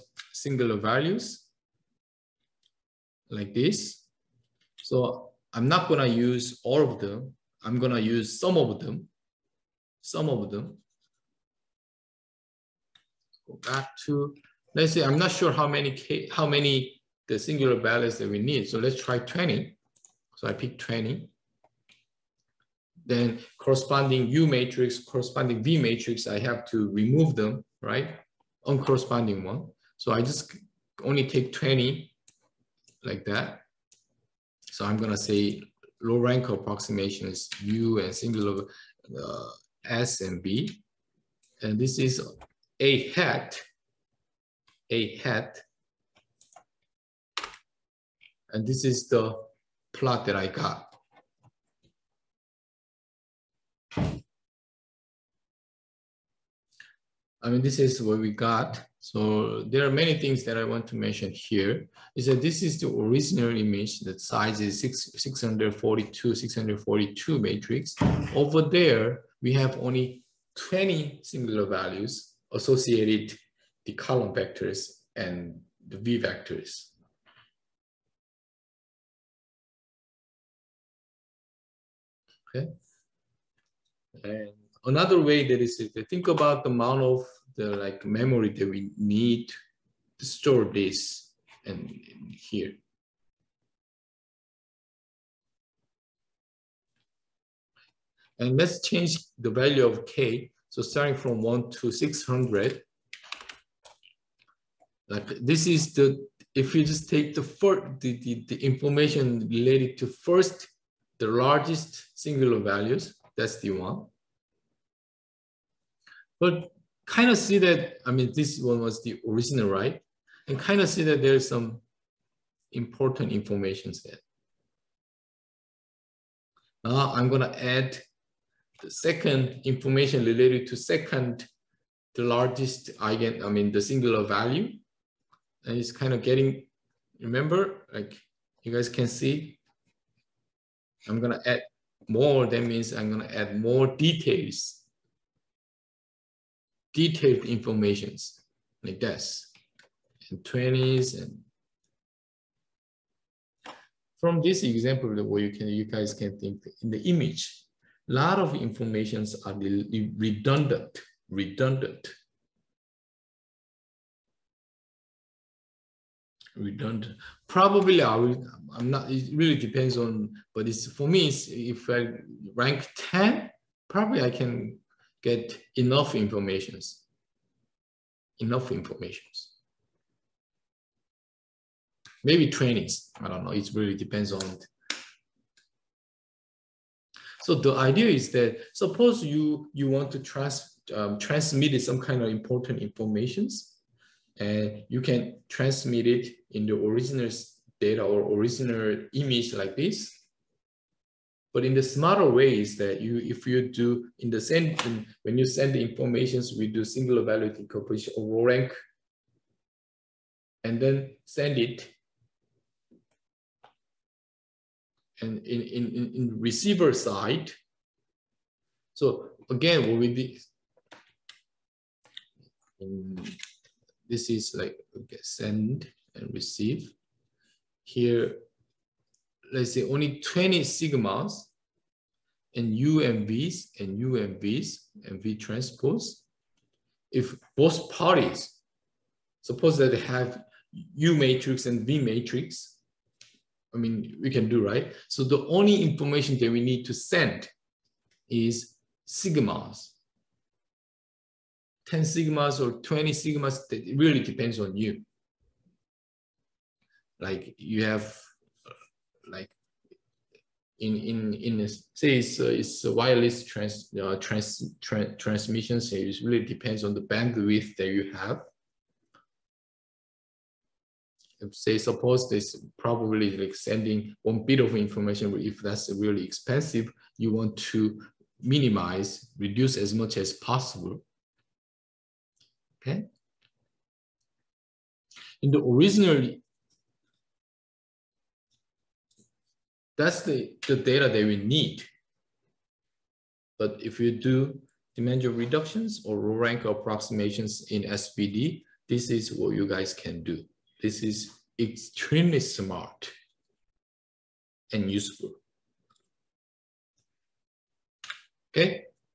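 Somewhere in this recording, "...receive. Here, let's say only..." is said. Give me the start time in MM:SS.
03:46.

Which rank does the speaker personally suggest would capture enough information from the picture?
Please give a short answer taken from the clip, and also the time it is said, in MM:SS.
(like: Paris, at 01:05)
10, at 02:51.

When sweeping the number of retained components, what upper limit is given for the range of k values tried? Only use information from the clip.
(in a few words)
600.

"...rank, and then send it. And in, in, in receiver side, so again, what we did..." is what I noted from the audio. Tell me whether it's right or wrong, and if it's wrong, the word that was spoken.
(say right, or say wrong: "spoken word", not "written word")
right.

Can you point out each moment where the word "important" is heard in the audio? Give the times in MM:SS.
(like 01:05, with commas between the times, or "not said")
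02:02, 03:12.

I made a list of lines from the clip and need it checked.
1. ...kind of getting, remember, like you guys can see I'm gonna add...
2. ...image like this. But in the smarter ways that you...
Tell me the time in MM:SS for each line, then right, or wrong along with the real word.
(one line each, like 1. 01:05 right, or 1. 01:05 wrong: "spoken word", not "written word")
1. 02:15 right
2. 03:19 right.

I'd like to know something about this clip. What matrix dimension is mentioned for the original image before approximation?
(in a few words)
642.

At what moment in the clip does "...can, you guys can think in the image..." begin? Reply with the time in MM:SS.
02:35.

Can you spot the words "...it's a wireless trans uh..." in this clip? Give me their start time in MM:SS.
04:22.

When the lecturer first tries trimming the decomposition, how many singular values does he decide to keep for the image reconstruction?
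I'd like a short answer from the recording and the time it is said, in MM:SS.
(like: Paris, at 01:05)
20, at 00:18.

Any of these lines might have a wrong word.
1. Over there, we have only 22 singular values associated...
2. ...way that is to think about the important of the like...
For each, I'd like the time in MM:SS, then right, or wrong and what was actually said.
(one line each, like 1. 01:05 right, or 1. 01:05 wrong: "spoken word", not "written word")
1. 01:08 wrong: "20", not "22"
2. 01:25 wrong: "amount", not "important".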